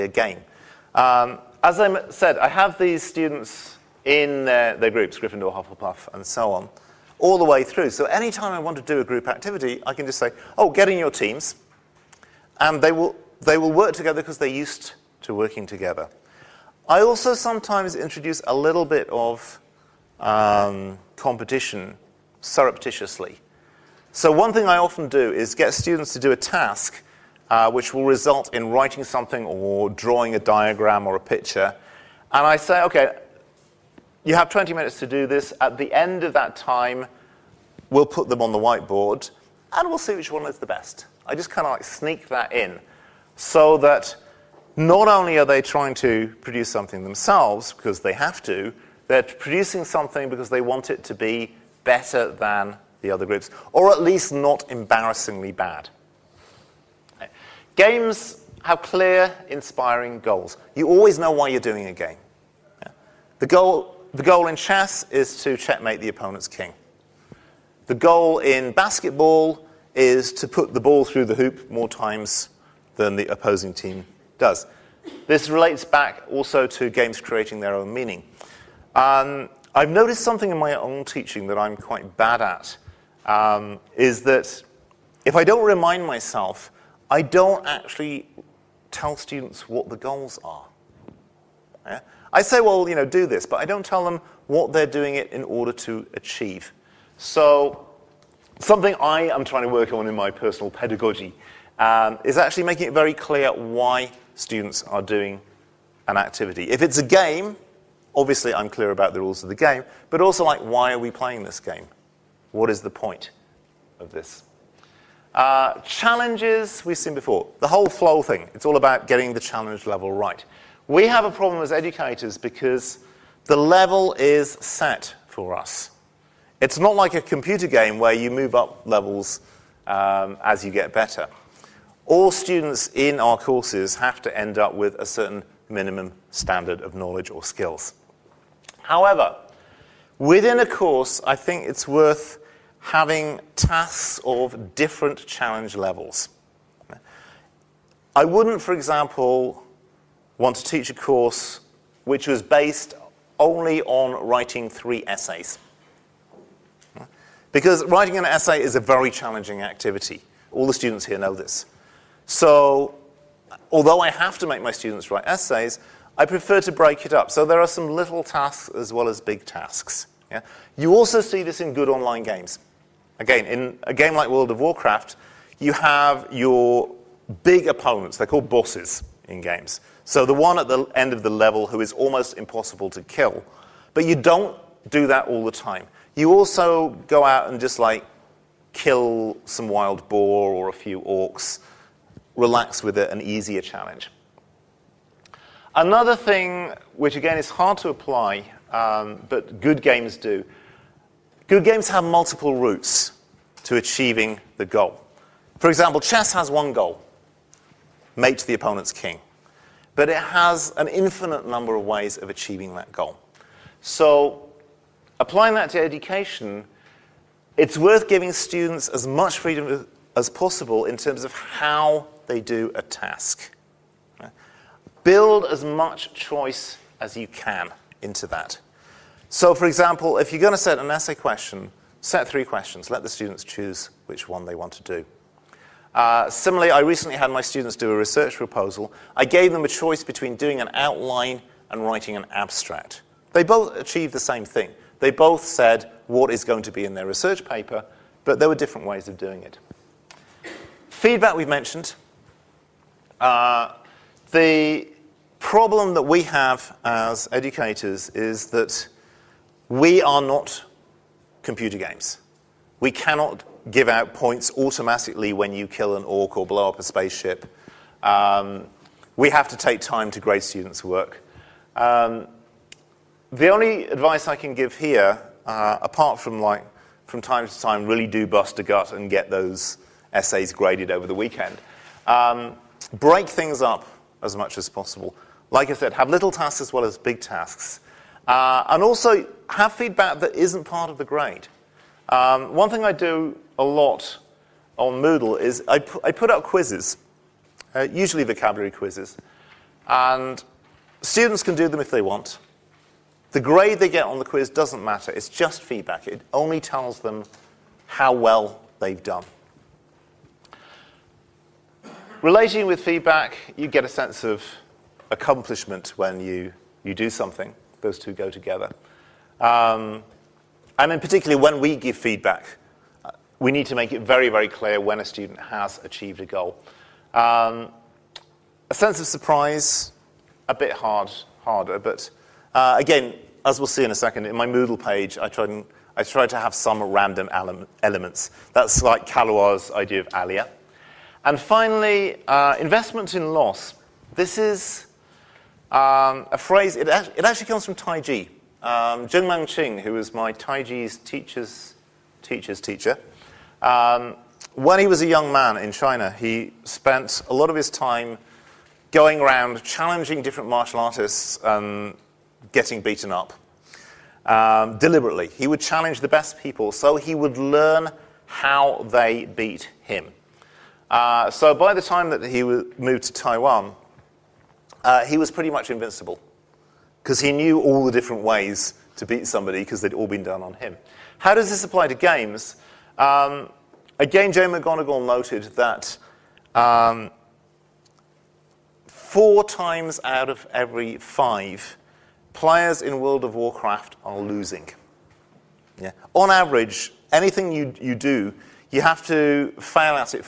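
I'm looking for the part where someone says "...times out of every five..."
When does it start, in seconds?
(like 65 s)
389 s.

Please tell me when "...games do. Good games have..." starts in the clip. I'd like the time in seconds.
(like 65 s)
199 s.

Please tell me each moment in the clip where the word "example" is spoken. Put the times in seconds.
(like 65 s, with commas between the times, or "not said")
148 s, 205 s, 229 s.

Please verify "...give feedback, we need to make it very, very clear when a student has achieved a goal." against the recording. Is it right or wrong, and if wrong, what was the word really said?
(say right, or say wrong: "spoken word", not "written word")
right.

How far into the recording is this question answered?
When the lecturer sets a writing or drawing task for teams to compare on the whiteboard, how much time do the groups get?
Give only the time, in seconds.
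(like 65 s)
34 s.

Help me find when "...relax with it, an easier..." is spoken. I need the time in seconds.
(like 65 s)
192 s.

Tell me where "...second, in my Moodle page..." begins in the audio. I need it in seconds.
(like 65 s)
333 s.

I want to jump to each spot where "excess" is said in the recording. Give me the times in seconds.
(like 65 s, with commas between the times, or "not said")
not said.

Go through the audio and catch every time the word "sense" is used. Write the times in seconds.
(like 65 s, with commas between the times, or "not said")
313 s, 328 s.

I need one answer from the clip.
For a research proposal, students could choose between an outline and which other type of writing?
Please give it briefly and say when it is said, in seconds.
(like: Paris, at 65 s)
an abstract, at 242 s.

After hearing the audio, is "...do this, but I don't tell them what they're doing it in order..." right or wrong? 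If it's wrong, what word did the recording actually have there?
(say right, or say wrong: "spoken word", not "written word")
right.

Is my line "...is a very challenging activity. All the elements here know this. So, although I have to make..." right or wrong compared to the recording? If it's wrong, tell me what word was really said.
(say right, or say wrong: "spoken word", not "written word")
wrong: "students", not "elements".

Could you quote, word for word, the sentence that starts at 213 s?
So applying that to education, it's worth giving students as much freedom as possible in terms of how they do a task.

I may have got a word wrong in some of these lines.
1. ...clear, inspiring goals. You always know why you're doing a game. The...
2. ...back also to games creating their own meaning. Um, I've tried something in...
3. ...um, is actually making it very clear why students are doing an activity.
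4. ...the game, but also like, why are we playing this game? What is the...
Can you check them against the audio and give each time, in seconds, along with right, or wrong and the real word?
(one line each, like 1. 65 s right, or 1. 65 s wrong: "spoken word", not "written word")
1. 58 s right
2. 75 s wrong: "noticed", not "tried"
3. 101 s right
4. 109 s right.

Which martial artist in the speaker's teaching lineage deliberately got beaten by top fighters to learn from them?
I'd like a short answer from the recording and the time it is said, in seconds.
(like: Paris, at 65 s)
Zheng Manqing, at 349 s.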